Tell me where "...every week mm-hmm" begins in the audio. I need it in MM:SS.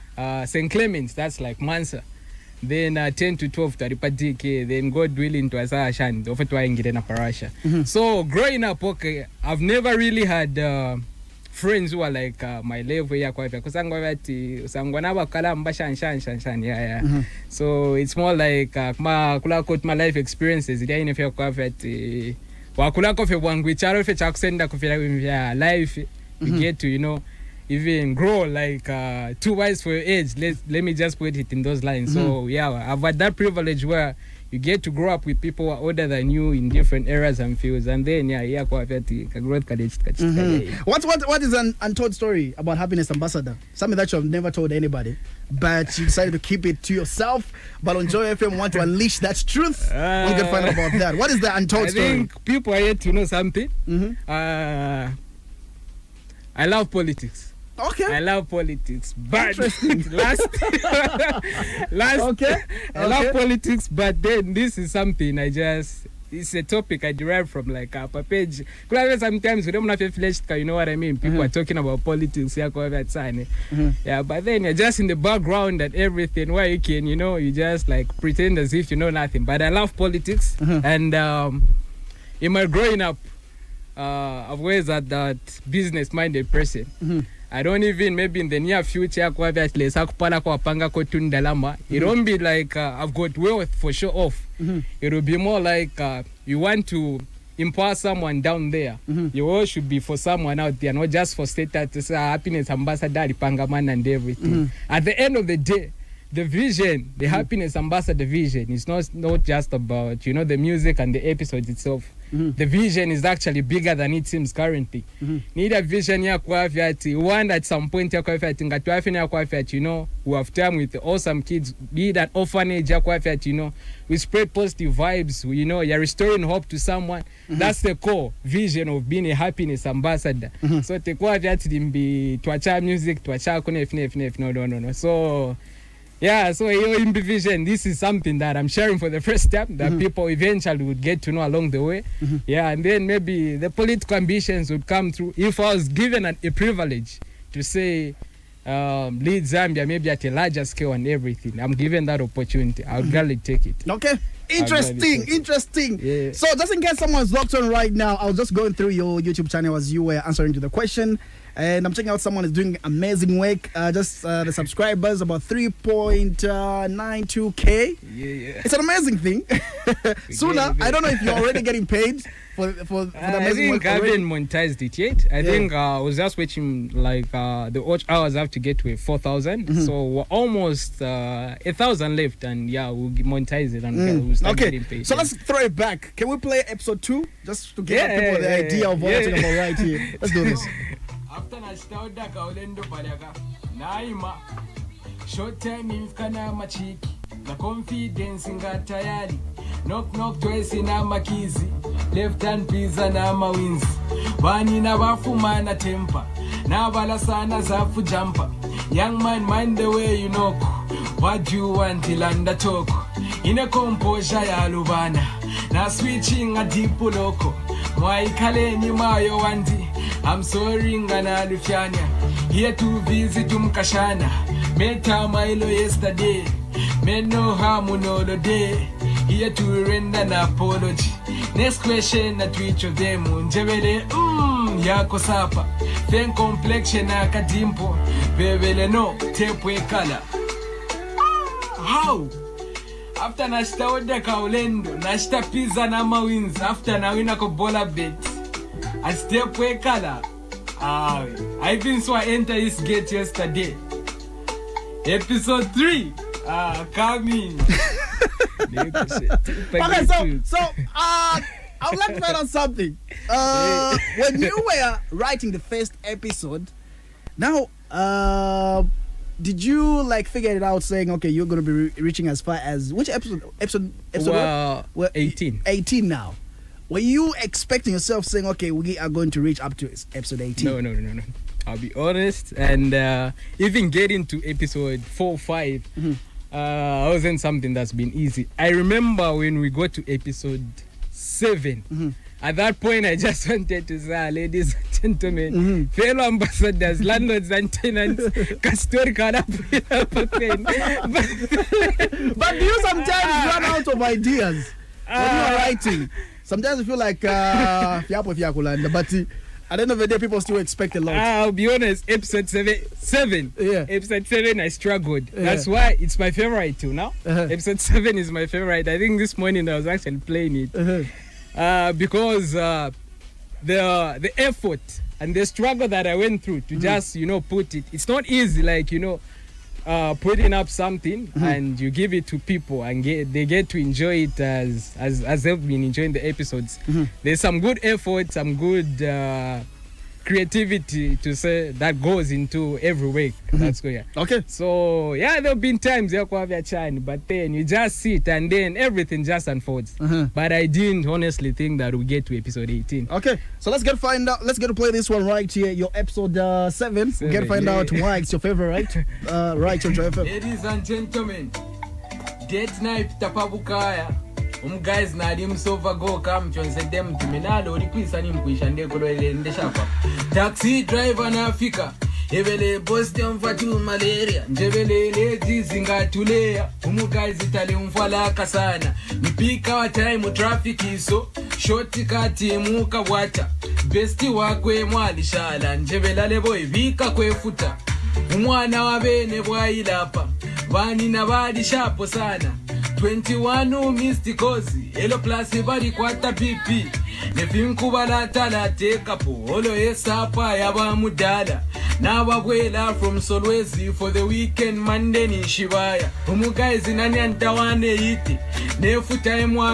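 05:42.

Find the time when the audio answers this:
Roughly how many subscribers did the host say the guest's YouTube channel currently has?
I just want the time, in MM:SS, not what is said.
02:45.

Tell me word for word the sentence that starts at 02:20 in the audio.
people eventually would get to know along the way.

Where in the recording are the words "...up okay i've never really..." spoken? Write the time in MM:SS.
00:08.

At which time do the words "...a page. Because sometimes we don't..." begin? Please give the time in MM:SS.
01:07.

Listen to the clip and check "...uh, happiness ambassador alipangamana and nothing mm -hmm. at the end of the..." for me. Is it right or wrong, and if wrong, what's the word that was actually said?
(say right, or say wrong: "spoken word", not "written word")
wrong: "everything", not "nothing".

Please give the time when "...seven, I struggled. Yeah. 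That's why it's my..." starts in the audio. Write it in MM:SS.
05:14.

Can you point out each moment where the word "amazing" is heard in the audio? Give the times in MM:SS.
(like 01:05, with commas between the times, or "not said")
02:42, 02:48, 02:53.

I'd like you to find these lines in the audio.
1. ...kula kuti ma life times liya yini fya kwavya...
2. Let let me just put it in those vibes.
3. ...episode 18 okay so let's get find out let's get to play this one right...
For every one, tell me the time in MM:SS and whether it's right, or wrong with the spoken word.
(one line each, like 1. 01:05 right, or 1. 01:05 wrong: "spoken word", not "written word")
1. 00:19 wrong: "experiences", not "times"
2. 00:30 wrong: "lines", not "vibes"
3. 05:52 right.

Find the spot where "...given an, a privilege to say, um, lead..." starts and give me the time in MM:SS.
02:25.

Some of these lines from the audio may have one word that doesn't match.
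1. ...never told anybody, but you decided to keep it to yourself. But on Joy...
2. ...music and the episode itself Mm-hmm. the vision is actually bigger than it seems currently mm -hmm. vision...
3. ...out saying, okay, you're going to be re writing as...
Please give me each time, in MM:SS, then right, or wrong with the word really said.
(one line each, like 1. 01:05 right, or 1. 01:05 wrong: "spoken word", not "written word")
1. 00:44 right
2. 01:50 right
3. 04:30 wrong: "reaching", not "writing".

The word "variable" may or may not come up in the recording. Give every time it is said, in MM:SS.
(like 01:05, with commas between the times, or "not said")
not said.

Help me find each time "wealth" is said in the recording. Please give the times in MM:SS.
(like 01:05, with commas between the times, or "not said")
01:33.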